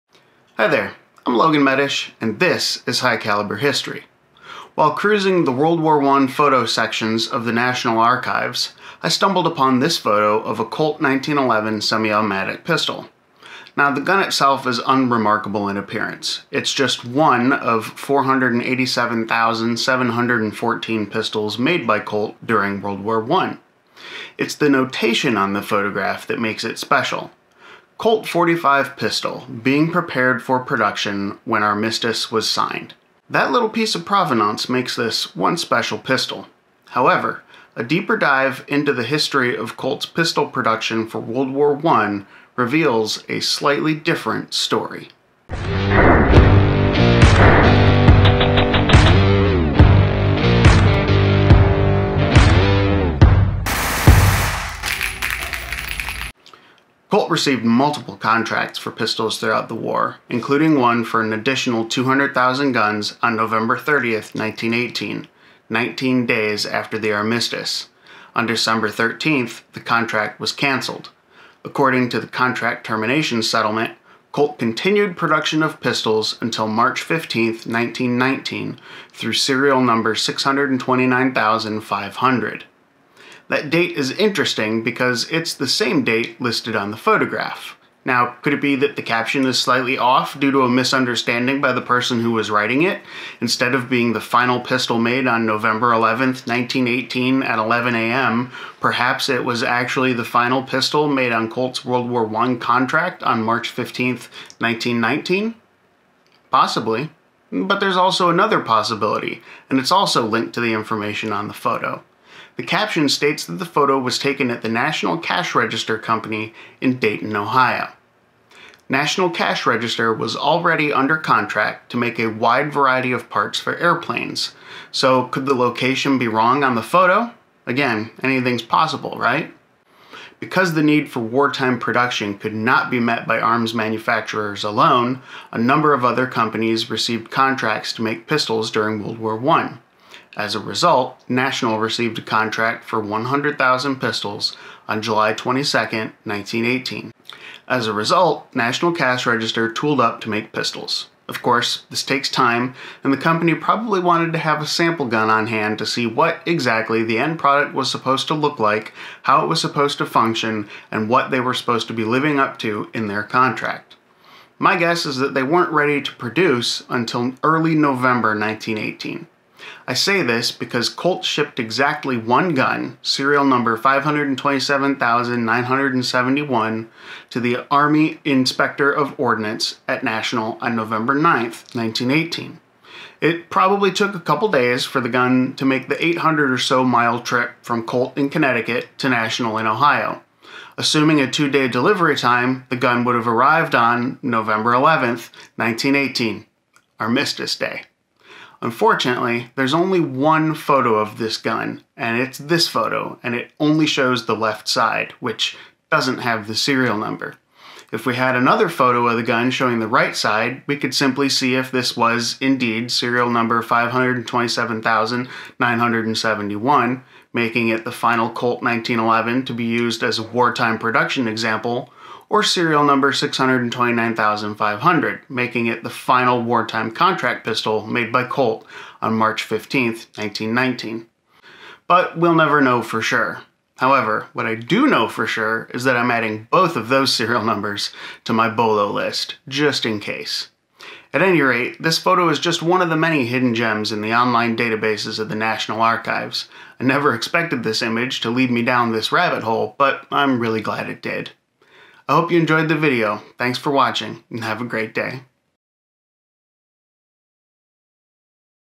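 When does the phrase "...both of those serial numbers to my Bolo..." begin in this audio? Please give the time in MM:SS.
03:56.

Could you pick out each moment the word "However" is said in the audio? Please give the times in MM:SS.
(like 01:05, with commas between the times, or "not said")
00:36, 03:53.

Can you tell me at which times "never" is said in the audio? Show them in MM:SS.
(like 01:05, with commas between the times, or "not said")
03:52, 04:06.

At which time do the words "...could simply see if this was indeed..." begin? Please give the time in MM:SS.
03:30.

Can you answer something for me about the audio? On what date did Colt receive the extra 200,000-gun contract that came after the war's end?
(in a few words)
November 30, 1918.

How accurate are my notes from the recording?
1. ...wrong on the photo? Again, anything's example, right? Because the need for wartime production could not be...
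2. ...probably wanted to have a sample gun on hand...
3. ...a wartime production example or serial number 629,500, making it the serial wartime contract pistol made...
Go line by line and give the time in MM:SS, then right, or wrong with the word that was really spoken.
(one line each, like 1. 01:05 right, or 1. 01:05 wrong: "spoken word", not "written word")
1. 02:06 wrong: "possible", not "example"
2. 02:33 right
3. 03:40 wrong: "final", not "serial".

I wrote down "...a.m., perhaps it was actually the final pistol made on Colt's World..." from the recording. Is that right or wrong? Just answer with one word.
right.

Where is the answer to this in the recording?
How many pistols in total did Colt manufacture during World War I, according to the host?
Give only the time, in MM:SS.
00:17.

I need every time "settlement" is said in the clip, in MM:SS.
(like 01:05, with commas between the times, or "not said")
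01:13.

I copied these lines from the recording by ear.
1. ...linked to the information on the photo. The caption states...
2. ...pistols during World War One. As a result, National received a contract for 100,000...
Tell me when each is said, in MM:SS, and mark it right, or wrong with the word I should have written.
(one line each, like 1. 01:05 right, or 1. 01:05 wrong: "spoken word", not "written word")
1. 01:50 right
2. 02:18 right.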